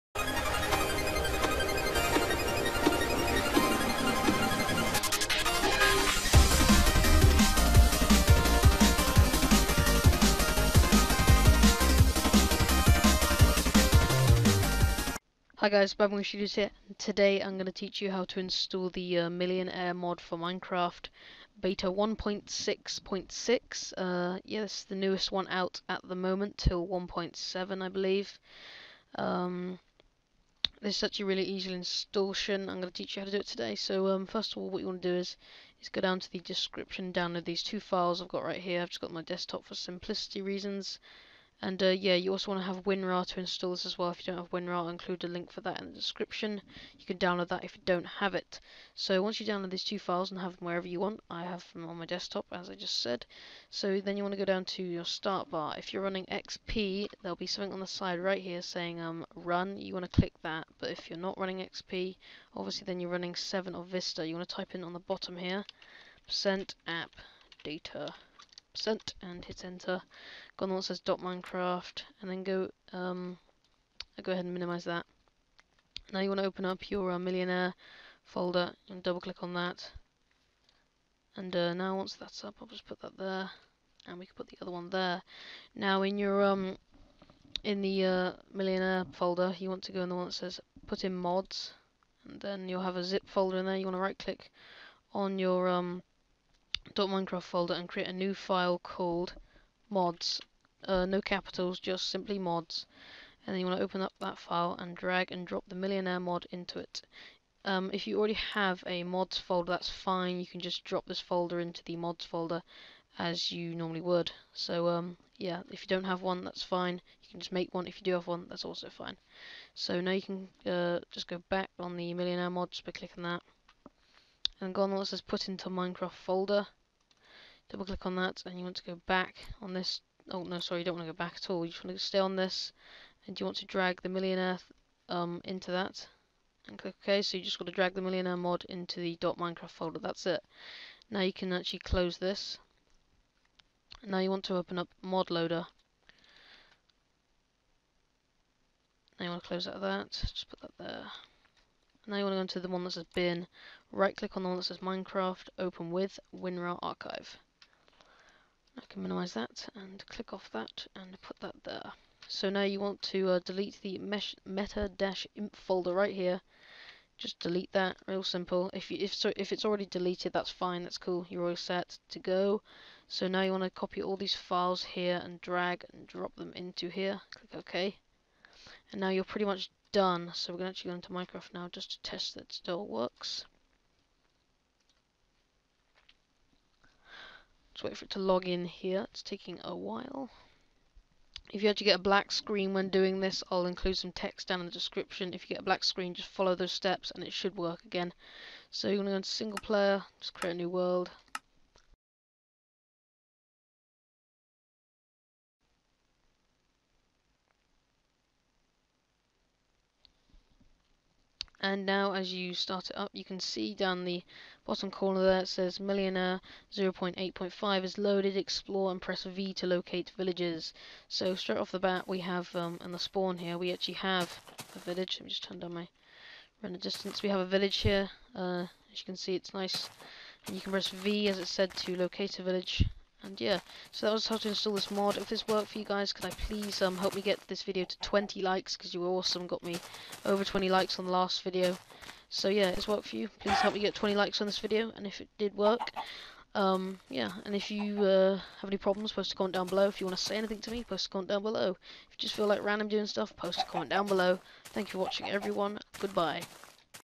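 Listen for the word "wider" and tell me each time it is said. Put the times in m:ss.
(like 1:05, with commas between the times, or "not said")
not said.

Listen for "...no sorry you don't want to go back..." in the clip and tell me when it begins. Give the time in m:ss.
2:10.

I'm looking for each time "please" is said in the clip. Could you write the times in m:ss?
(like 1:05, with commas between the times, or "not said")
3:56, 4:03.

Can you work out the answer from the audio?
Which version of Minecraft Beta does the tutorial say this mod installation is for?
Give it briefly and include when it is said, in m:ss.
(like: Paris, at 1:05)
Beta 1.6.6, at 0:21.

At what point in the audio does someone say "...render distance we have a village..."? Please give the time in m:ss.
3:46.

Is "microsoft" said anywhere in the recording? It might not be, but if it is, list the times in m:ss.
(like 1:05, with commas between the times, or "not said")
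not said.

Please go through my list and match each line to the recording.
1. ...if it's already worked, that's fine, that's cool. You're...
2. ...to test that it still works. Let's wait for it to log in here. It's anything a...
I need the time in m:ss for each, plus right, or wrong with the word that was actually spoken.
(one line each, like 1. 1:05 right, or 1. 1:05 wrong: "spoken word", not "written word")
1. 2:49 wrong: "deleted", not "worked"
2. 3:01 wrong: "taking", not "anything".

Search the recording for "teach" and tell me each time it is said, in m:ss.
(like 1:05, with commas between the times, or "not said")
0:17, 0:32.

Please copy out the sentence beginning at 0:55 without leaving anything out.
If you're running XP, there'll be something on the side right here saying um, run.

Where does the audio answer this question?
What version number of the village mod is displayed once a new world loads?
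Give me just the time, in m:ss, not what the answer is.
3:36.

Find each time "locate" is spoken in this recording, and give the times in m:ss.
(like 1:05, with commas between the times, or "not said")
3:39, 3:51.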